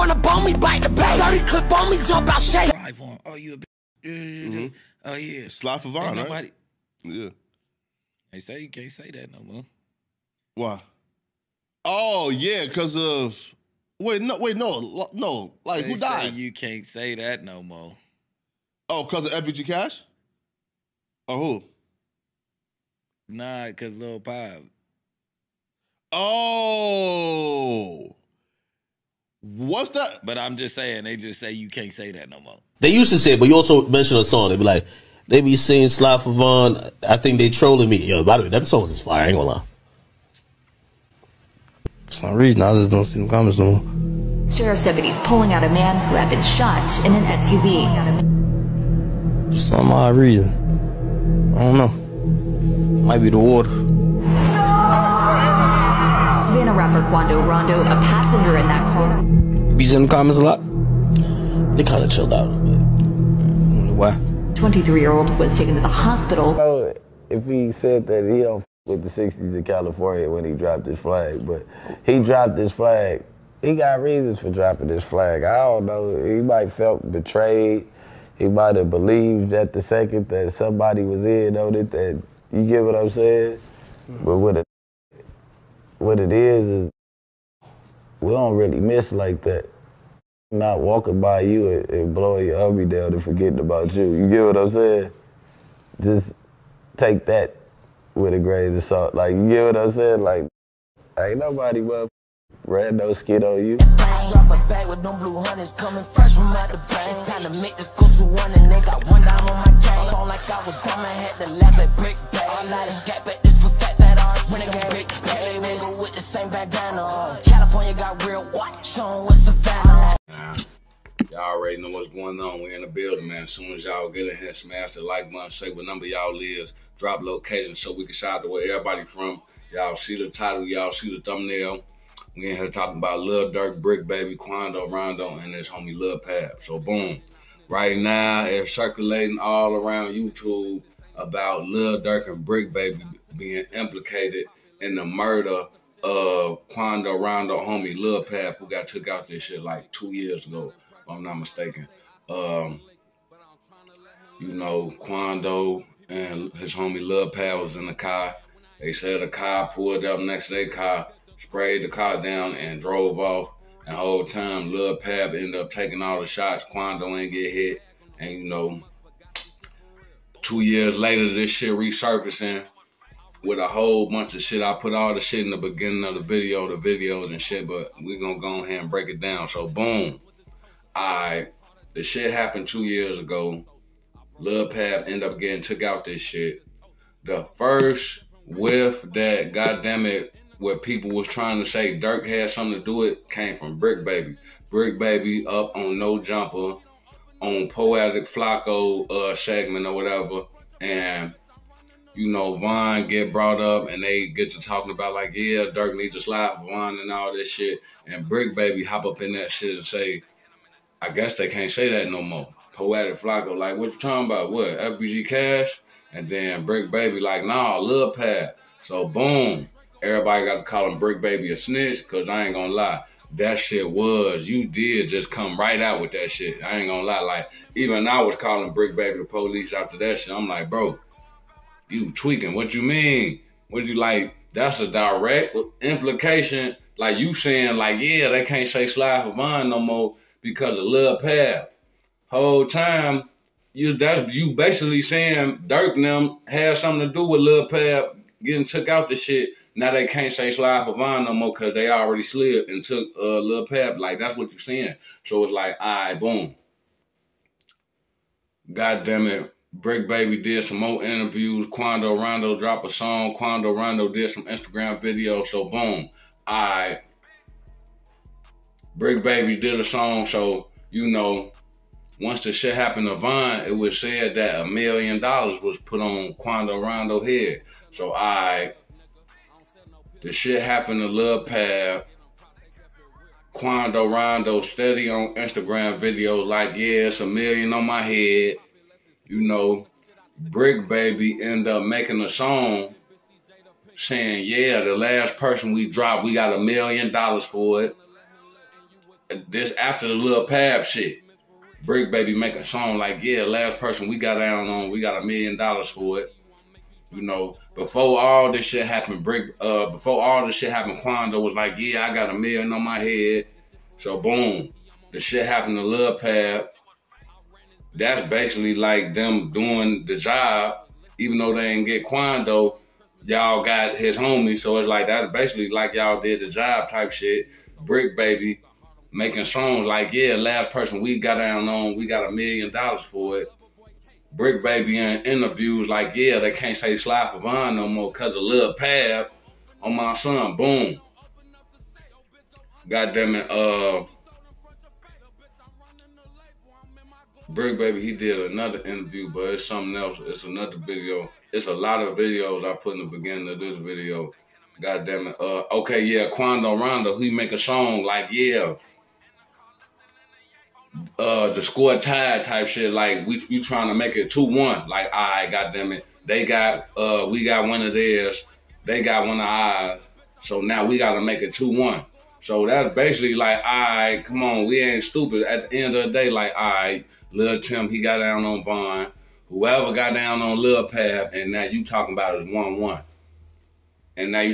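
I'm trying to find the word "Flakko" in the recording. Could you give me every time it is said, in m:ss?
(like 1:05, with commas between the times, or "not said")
3:18, 3:33.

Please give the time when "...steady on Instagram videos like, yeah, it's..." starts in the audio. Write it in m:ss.
4:44.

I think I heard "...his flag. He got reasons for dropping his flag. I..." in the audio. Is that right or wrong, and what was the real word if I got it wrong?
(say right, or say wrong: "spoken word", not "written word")
right.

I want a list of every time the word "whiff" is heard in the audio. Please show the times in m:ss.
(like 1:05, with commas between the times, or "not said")
3:08.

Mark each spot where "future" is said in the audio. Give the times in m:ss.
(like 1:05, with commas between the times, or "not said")
not said.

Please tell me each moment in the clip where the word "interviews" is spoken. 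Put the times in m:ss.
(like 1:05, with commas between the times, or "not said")
4:21, 5:35, 5:48.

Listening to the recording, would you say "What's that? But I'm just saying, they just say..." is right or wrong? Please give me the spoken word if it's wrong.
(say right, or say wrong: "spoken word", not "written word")
right.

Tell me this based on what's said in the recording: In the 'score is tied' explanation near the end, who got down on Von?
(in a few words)
Little Tim.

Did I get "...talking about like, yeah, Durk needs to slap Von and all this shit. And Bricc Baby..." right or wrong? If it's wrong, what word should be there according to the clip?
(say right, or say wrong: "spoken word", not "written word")
right.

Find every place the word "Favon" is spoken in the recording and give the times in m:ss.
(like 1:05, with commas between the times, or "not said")
0:05, 0:36.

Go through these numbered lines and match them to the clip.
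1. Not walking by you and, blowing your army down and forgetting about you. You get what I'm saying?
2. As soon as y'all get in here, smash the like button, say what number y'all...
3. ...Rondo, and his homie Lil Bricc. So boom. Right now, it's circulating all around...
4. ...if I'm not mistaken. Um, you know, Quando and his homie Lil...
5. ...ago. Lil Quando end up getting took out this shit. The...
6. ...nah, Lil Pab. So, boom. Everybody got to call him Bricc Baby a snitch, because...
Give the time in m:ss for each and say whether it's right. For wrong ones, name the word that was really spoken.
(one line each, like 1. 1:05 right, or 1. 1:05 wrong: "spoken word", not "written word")
1. 1:30 right
2. 2:03 right
3. 2:14 wrong: "Pab", not "Bricc"
4. 2:30 right
5. 3:03 wrong: "Pab", not "Quando"
6. 3:37 right.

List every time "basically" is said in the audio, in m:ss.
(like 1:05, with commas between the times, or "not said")
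4:04, 5:18, 5:25, 6:12.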